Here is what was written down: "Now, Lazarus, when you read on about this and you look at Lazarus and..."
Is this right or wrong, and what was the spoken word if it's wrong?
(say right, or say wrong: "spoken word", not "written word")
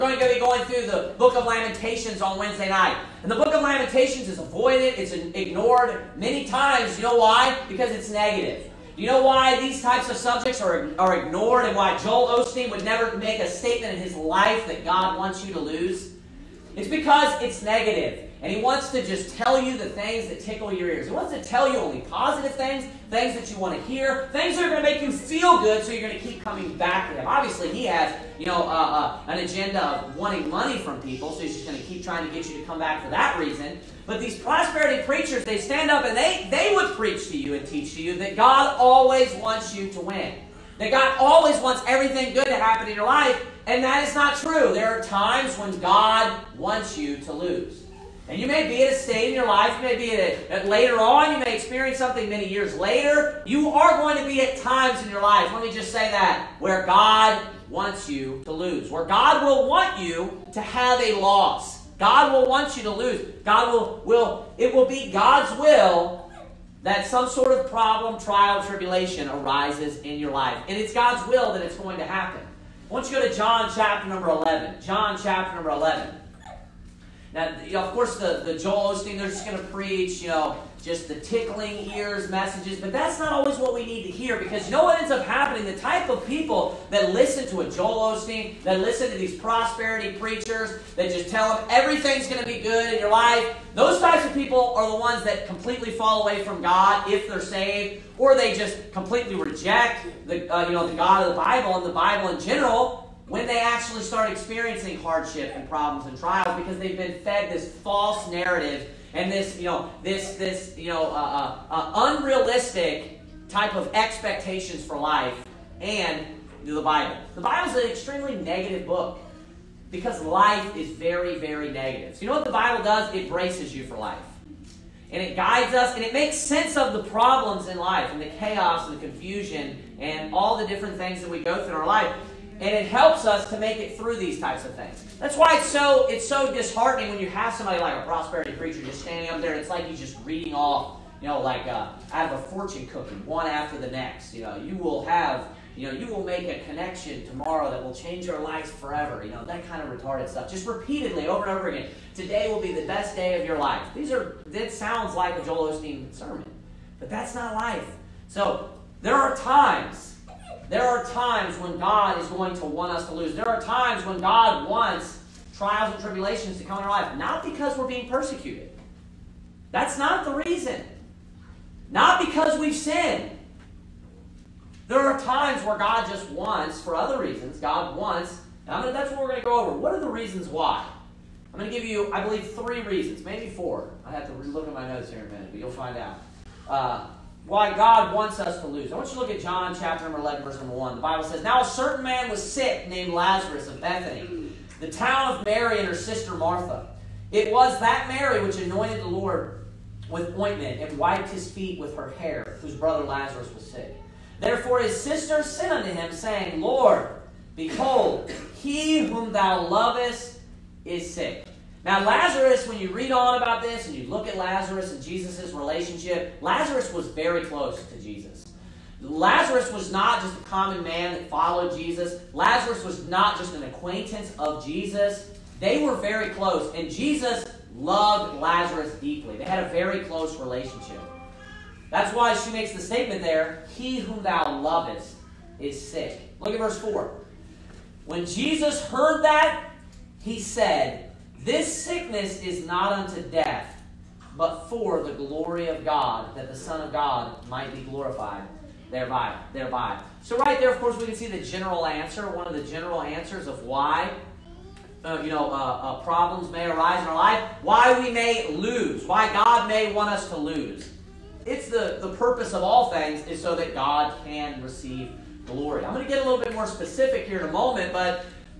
right.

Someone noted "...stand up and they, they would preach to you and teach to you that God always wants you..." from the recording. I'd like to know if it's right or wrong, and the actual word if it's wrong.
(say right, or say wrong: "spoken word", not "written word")
right.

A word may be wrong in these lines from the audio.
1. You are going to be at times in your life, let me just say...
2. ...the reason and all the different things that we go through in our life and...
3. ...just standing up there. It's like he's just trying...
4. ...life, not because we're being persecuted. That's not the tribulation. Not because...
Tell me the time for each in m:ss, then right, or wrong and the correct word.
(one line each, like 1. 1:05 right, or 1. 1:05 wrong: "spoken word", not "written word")
1. 0:53 right
2. 2:08 wrong: "confusion", not "reason"
3. 2:18 wrong: "reading", not "trying"
4. 2:46 wrong: "reason", not "tribulation".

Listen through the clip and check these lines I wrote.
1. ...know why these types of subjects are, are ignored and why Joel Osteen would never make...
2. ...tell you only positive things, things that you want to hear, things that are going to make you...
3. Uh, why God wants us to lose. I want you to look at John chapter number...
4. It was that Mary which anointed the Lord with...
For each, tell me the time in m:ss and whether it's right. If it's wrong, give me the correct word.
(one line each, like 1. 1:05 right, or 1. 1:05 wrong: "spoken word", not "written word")
1. 0:09 right
2. 0:21 right
3. 3:06 right
4. 3:17 right.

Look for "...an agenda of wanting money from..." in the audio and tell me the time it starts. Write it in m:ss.
0:29.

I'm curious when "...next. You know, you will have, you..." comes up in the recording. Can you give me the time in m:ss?
2:23.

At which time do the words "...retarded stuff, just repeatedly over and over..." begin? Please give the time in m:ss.
2:29.